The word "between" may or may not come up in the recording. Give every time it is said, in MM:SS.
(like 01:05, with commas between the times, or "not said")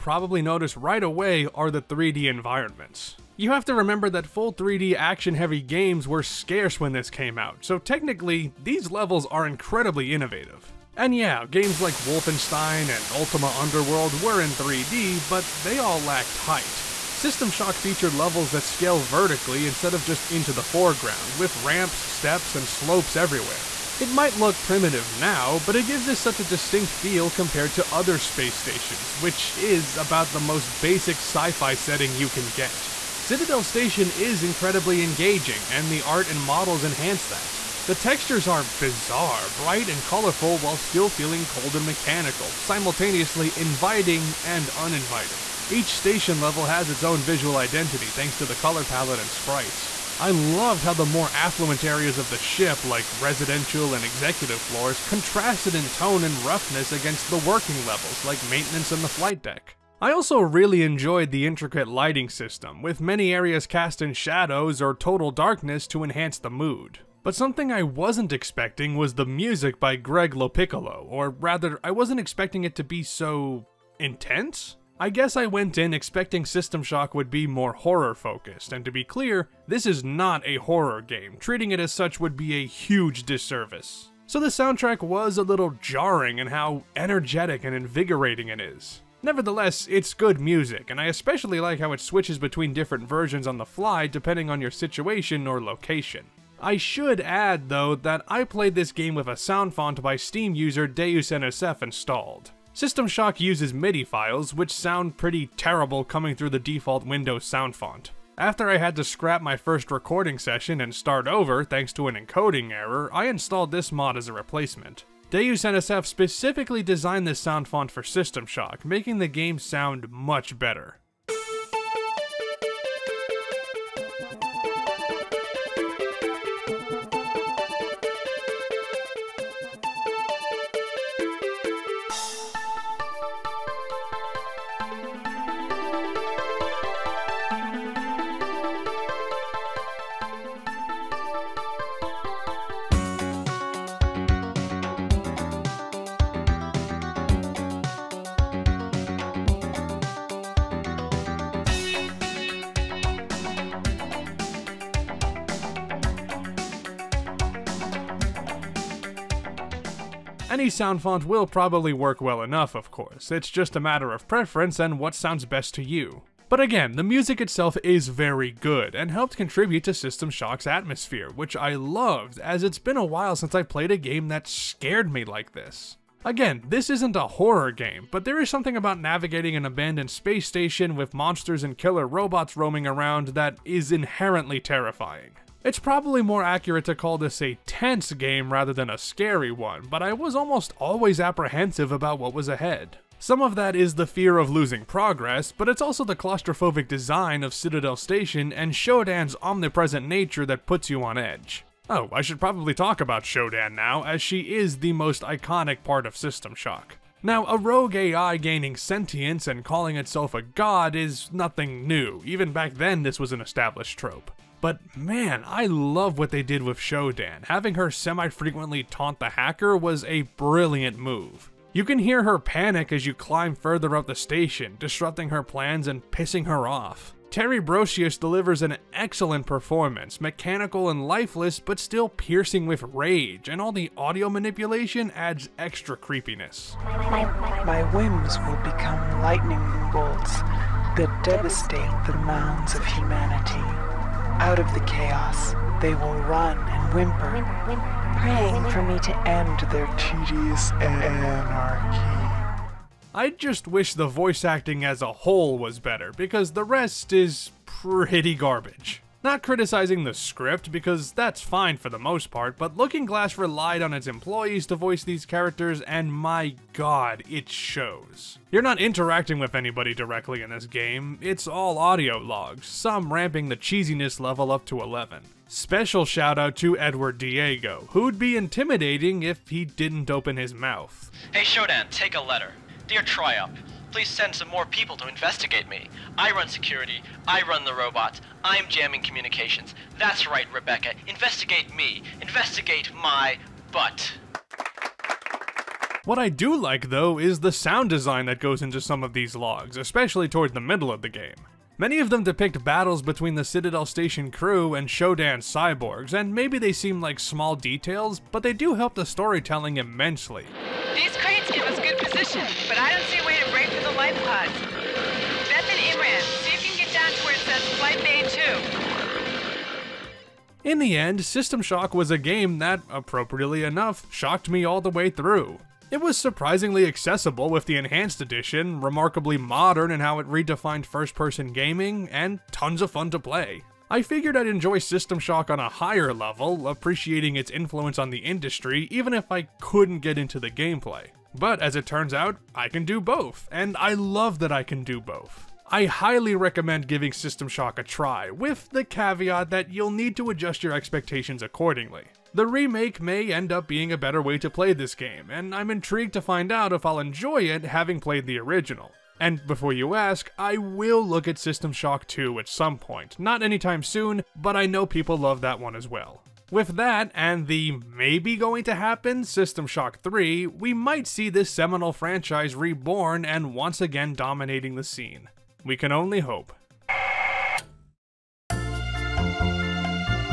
01:32, 05:03.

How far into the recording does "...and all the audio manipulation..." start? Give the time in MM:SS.
03:53.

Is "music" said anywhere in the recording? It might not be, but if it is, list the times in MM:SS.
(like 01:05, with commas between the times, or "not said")
01:09, 01:30, 02:47.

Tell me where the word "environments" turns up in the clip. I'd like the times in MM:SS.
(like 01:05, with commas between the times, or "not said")
00:02.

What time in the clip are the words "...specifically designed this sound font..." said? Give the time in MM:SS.
01:56.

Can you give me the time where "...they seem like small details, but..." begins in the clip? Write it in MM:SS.
05:06.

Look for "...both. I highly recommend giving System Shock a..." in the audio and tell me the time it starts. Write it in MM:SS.
05:45.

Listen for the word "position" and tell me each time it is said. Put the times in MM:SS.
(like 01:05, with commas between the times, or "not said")
05:11.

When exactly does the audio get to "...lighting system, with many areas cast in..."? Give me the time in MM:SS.
01:01.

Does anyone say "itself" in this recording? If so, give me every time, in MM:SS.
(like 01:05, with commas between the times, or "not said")
02:47, 03:29.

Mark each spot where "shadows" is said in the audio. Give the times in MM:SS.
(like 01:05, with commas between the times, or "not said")
01:04.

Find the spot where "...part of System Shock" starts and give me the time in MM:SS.
03:25.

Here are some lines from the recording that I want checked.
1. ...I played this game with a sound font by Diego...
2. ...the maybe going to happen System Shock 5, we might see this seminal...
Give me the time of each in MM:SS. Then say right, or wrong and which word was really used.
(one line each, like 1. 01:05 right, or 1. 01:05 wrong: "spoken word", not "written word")
1. 01:38 wrong: "Steam", not "Diego"
2. 06:07 wrong: "3", not "5".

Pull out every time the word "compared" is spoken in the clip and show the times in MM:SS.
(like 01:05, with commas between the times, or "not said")
00:27.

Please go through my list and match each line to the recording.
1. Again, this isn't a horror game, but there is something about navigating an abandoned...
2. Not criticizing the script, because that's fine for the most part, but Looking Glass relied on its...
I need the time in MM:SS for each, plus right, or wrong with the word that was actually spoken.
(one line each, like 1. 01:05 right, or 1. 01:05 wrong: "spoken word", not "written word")
1. 02:56 right
2. 04:19 right.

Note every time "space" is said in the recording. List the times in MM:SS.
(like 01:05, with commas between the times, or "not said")
00:28, 03:00.